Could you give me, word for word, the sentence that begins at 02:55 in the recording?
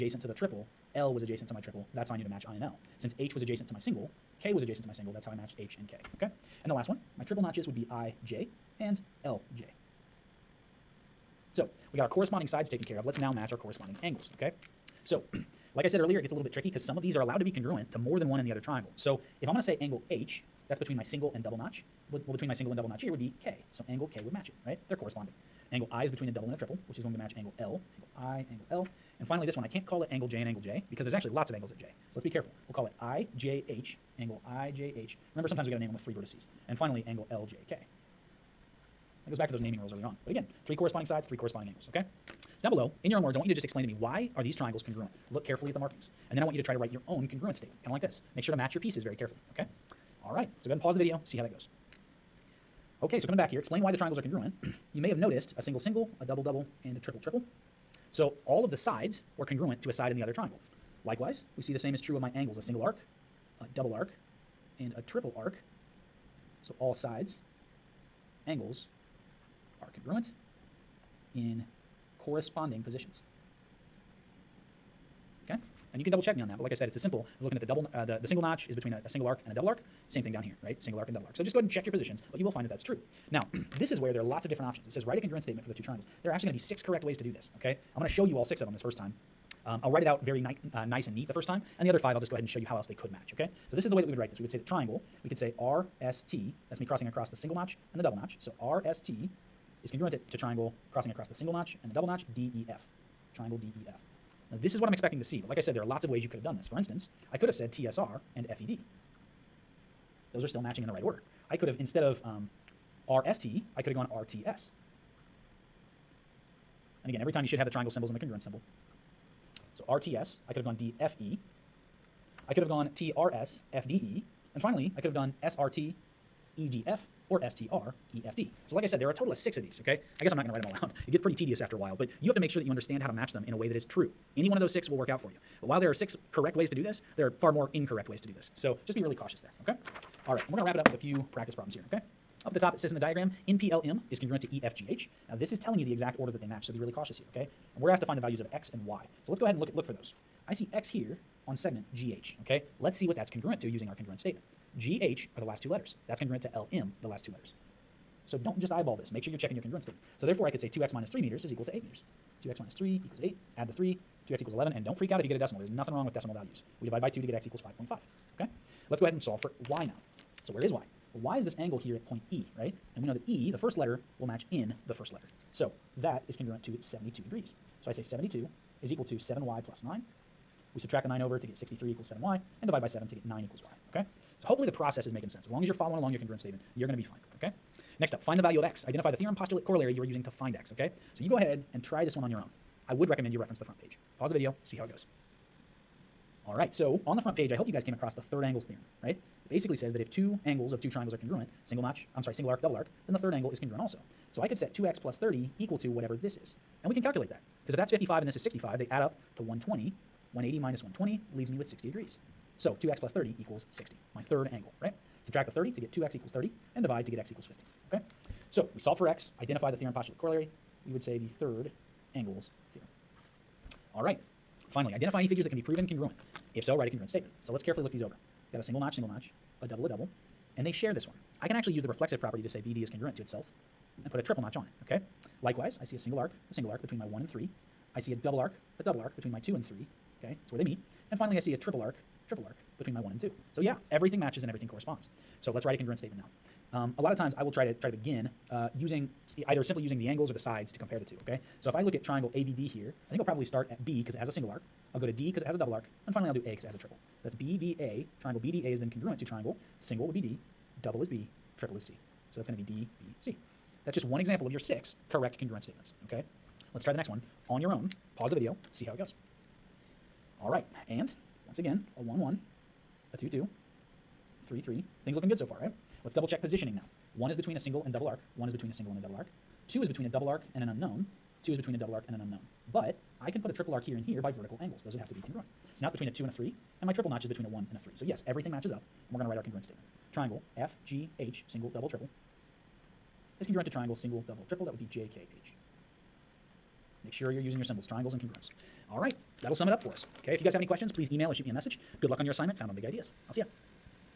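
So that is congruent to 72 degrees.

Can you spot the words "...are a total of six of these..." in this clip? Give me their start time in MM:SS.
02:09.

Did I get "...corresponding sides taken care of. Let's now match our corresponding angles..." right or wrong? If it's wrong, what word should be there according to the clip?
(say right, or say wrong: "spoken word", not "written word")
right.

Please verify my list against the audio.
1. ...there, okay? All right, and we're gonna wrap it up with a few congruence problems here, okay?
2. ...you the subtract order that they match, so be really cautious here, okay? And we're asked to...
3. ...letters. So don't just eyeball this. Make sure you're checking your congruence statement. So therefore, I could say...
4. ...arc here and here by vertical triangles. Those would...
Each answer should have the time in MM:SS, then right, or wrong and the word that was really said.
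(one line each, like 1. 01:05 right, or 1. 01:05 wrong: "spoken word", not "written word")
1. 02:19 wrong: "practice", not "congruence"
2. 02:25 wrong: "exact", not "subtract"
3. 02:37 right
4. 04:43 wrong: "angles", not "triangles".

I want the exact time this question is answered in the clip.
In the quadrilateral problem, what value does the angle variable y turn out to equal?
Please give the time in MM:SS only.
03:03.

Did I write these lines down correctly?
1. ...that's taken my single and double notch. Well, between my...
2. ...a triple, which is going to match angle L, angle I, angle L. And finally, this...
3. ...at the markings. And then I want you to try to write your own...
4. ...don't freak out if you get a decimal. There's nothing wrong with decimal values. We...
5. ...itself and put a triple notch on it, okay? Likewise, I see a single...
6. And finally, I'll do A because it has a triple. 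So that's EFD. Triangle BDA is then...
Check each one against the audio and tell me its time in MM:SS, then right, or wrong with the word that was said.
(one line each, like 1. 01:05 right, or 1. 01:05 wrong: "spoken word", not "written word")
1. 00:20 wrong: "between", not "taken"
2. 00:26 right
3. 00:45 right
4. 02:44 right
5. 03:53 right
6. 04:16 wrong: "BDA", not "EFD".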